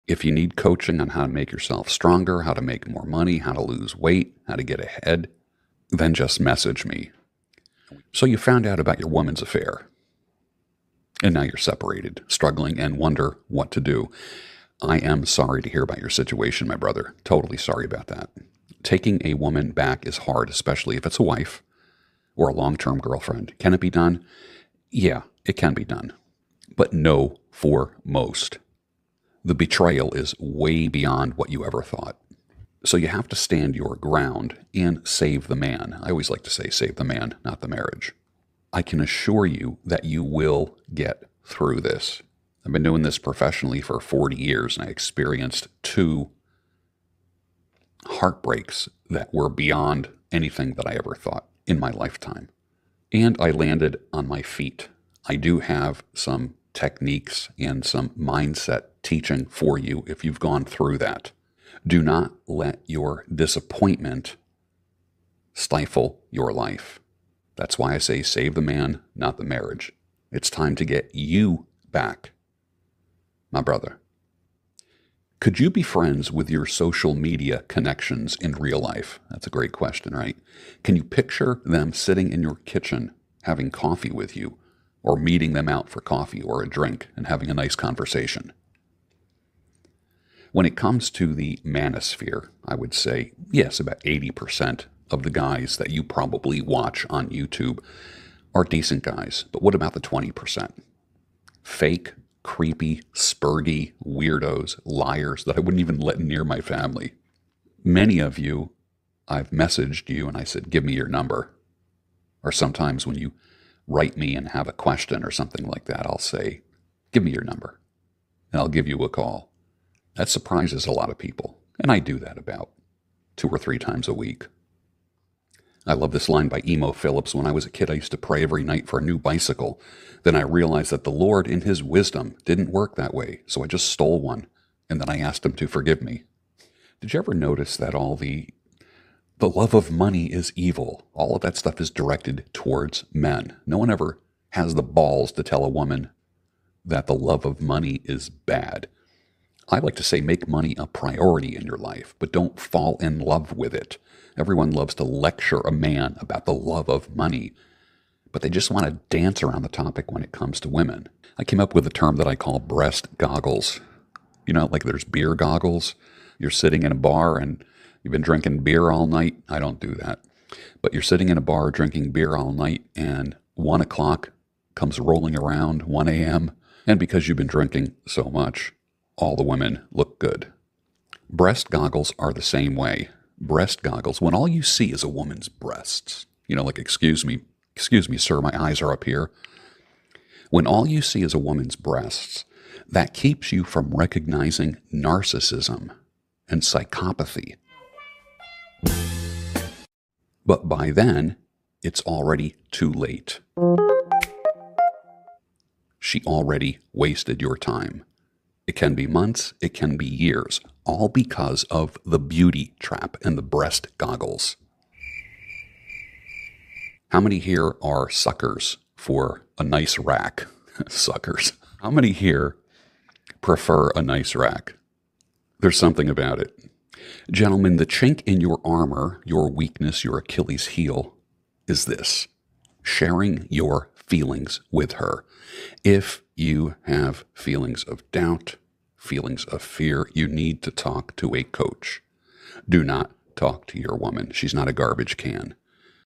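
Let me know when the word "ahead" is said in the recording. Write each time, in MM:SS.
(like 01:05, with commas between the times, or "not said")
00:04.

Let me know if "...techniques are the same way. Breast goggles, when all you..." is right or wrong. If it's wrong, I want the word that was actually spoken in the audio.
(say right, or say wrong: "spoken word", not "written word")
wrong: "goggles", not "techniques".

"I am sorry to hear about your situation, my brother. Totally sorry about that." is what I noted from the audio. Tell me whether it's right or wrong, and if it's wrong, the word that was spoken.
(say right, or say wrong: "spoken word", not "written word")
right.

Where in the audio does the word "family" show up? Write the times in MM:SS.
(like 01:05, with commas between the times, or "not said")
01:46.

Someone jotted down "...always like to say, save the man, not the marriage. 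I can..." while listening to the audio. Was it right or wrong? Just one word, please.
right.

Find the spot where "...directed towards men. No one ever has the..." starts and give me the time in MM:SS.
02:21.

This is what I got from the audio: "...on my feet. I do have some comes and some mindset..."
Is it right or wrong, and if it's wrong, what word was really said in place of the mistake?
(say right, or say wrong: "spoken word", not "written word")
wrong: "techniques", not "comes".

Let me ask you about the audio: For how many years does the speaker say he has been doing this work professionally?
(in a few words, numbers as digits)
40.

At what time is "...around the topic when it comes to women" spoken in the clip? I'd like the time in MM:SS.
02:39.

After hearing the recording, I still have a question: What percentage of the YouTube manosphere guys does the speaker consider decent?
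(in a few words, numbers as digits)
80%.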